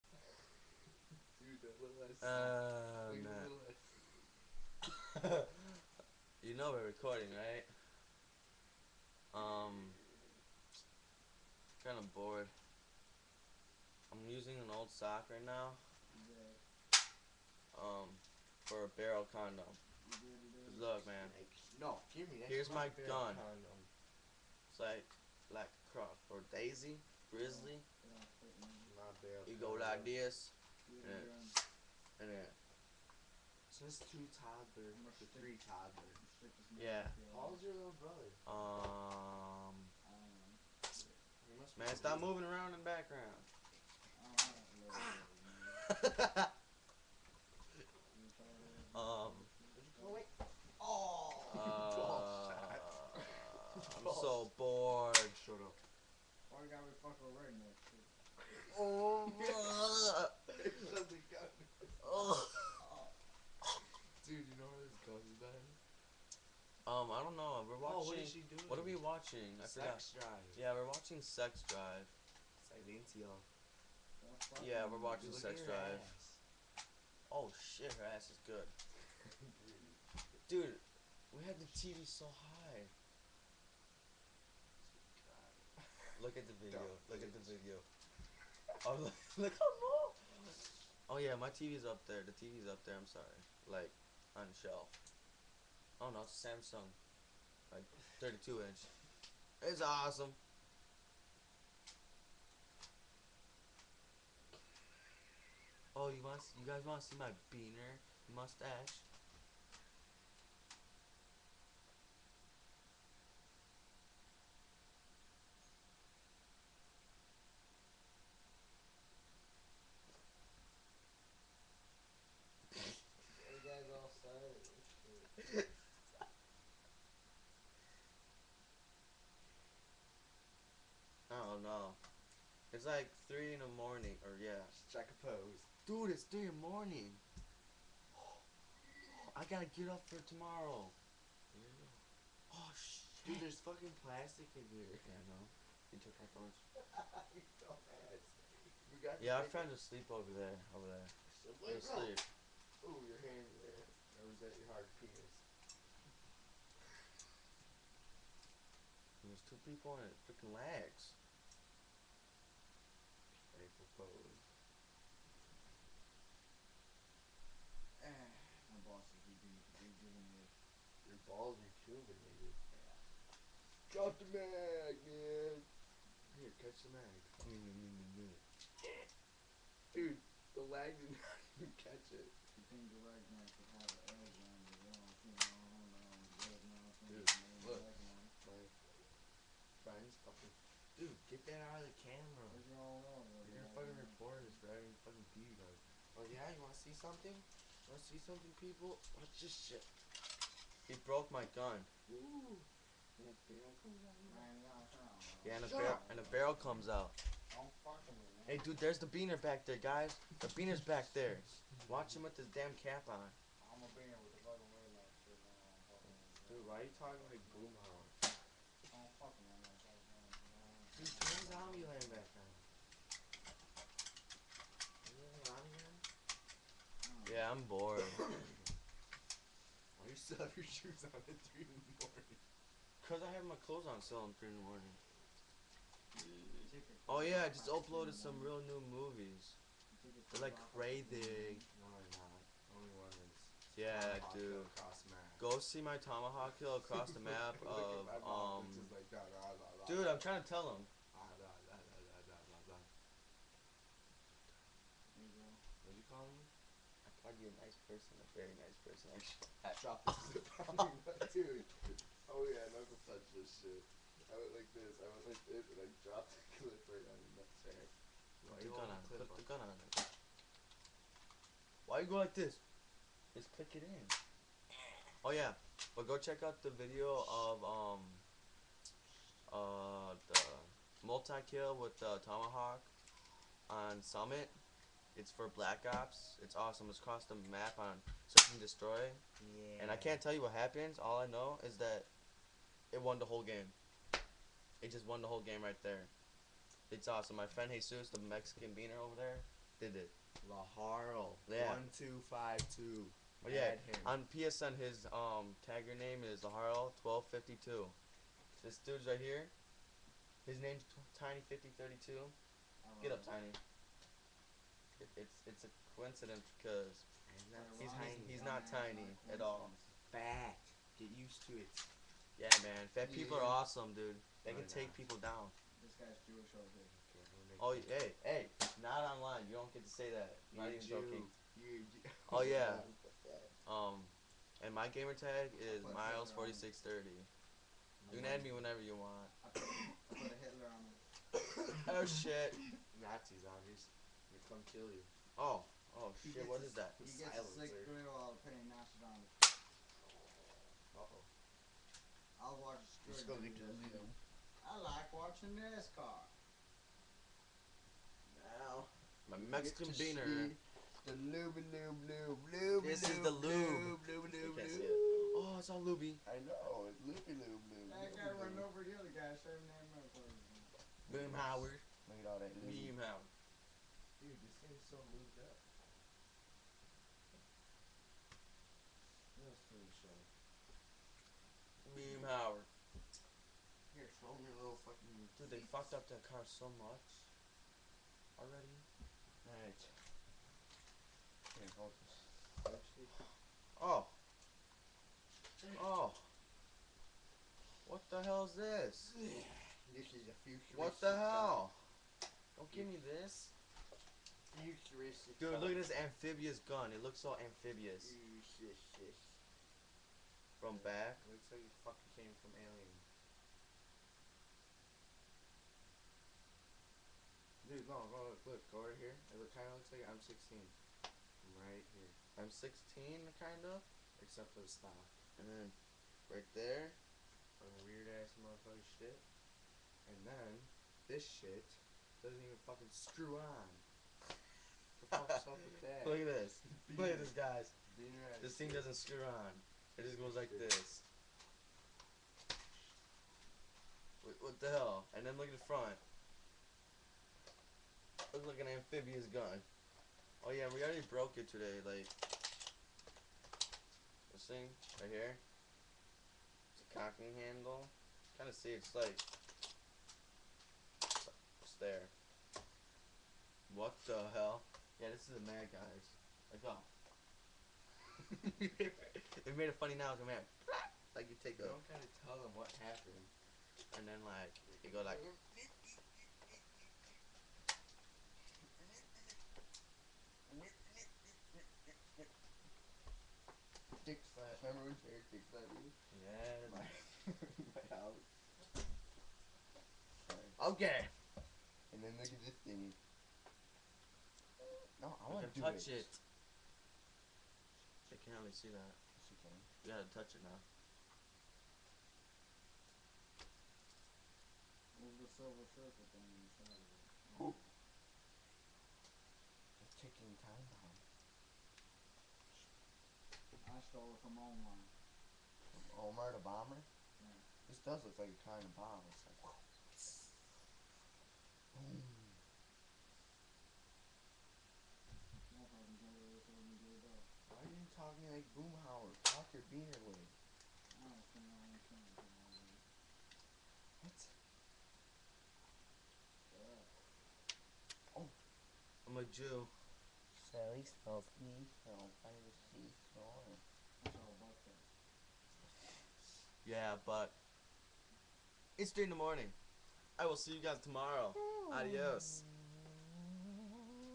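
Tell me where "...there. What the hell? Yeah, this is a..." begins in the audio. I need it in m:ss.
7:41.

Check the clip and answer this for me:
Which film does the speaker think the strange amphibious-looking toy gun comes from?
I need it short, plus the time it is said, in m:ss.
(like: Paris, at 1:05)
Alien, at 6:52.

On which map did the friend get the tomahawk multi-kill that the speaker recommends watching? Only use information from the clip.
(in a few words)
Summit.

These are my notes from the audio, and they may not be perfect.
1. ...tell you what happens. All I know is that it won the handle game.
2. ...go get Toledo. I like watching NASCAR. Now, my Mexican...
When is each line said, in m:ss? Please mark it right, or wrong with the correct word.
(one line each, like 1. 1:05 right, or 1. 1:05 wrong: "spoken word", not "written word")
1. 4:50 wrong: "whole", not "handle"
2. 5:53 right.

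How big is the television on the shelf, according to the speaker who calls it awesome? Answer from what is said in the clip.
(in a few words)
32 inch.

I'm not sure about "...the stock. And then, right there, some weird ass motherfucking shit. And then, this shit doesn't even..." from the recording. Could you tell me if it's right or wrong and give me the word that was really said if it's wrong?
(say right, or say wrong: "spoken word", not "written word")
right.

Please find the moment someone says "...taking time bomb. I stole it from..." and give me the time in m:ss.
8:29.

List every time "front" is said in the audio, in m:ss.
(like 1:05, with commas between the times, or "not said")
7:25.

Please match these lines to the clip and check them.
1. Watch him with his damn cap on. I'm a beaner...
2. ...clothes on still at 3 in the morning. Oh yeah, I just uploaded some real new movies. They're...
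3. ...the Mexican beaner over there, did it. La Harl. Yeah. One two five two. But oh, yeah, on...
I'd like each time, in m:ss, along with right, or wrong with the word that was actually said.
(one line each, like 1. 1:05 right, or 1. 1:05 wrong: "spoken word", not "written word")
1. 3:31 right
2. 3:53 right
3. 4:58 right.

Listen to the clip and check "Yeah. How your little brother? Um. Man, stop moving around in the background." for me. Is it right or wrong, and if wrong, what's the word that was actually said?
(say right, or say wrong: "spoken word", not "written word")
right.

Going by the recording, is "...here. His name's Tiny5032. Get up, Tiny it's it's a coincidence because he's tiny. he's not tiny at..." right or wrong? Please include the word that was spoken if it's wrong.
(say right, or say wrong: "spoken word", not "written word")
right.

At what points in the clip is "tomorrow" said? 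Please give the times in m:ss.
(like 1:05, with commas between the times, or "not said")
2:20, 9:10.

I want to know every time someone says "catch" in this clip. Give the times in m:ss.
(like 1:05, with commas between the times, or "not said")
2:56, 3:01.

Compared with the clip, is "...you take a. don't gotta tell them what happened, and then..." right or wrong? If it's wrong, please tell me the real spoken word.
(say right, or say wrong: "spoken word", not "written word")
right.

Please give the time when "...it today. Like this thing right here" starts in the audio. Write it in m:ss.
7:31.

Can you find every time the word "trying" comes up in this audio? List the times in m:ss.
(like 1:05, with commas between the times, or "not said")
2:29, 4:10.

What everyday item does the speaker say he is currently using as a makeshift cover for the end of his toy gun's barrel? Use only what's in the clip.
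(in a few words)
An old sock.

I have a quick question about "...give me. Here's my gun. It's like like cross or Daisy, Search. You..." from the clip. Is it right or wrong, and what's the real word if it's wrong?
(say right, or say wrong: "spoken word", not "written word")
wrong: "Grizzly", not "Search".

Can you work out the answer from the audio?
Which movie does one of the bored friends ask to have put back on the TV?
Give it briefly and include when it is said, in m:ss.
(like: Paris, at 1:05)
Zombieland, at 3:41.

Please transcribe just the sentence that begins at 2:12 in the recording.
It's like 3 in the morning, or yeah.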